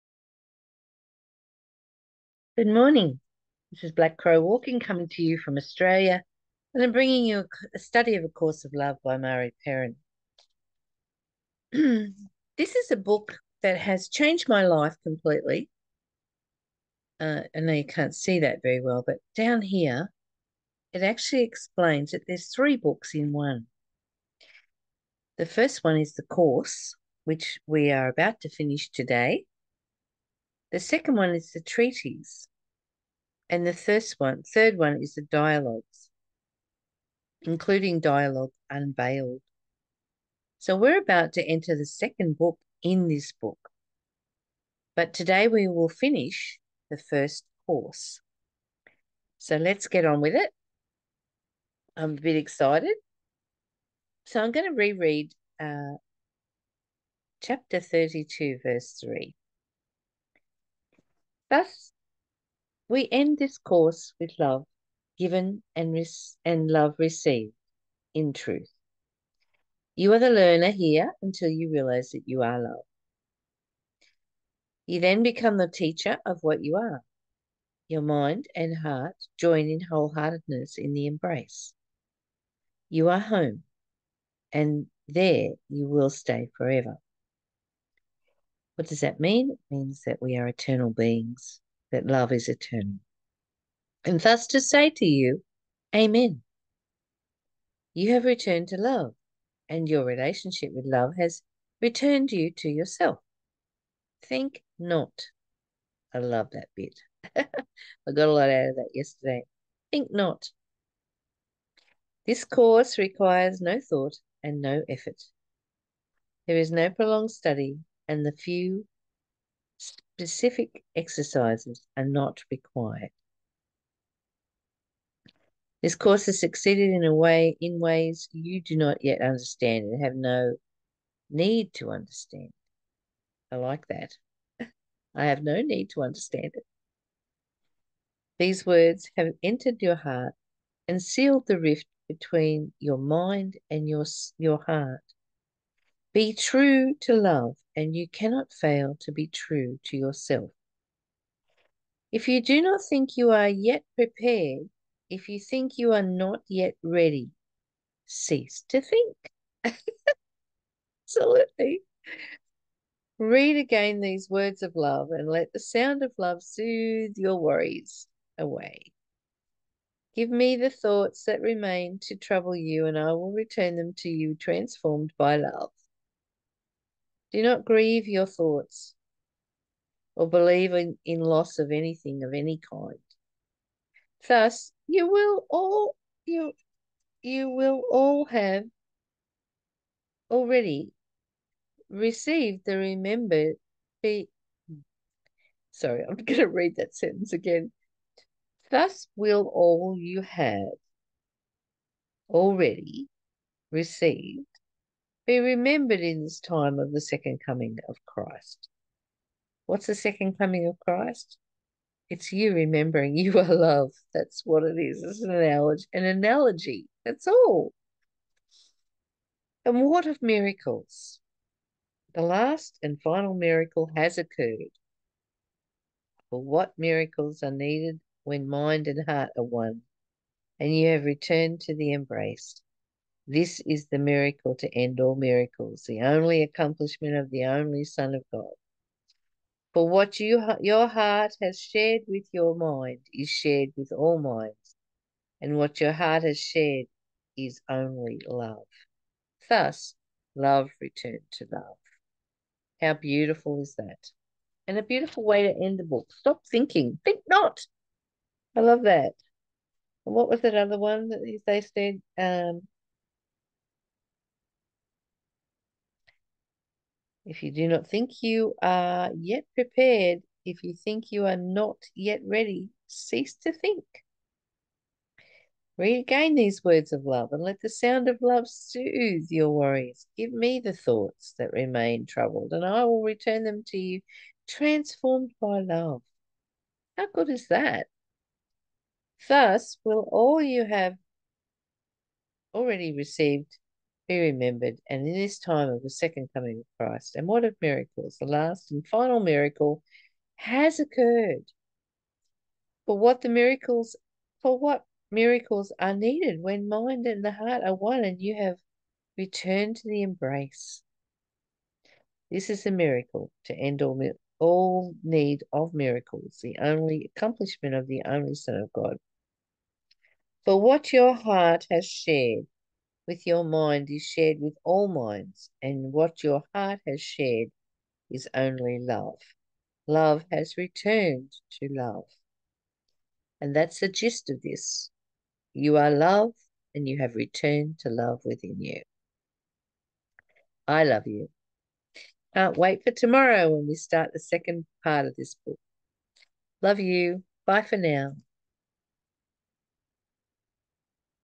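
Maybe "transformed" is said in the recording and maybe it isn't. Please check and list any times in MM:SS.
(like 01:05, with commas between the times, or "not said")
02:54, 04:44.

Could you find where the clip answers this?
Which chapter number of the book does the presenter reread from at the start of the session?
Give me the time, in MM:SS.
00:57.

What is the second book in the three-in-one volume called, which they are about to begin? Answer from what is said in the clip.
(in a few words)
The treatise.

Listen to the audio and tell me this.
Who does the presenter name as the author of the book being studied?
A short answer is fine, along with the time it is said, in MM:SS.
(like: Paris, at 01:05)
Murray Perrin, at 00:09.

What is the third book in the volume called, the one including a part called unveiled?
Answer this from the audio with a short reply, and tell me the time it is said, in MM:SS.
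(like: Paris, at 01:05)
The dialogues, at 00:35.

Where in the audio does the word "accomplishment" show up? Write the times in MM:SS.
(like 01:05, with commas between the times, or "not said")
03:56, 05:17.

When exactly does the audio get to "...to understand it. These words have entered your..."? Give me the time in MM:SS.
02:15.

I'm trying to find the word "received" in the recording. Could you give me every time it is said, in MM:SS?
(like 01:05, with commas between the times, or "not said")
01:06, 03:11, 03:23, 04:52.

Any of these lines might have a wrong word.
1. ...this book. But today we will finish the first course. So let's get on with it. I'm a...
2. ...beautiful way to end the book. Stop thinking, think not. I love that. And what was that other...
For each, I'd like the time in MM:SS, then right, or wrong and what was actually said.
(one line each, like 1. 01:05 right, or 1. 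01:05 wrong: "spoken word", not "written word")
1. 00:43 right
2. 04:14 right.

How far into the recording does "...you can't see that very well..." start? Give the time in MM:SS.
00:17.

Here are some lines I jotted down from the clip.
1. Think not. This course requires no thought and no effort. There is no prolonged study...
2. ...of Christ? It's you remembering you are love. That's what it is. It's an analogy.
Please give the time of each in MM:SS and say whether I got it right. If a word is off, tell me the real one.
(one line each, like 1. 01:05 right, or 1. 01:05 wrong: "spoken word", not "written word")
1. 01:49 right
2. 03:30 right.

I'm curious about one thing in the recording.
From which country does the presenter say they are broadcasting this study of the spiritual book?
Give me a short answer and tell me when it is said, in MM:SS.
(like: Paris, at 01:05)
Australia, at 00:05.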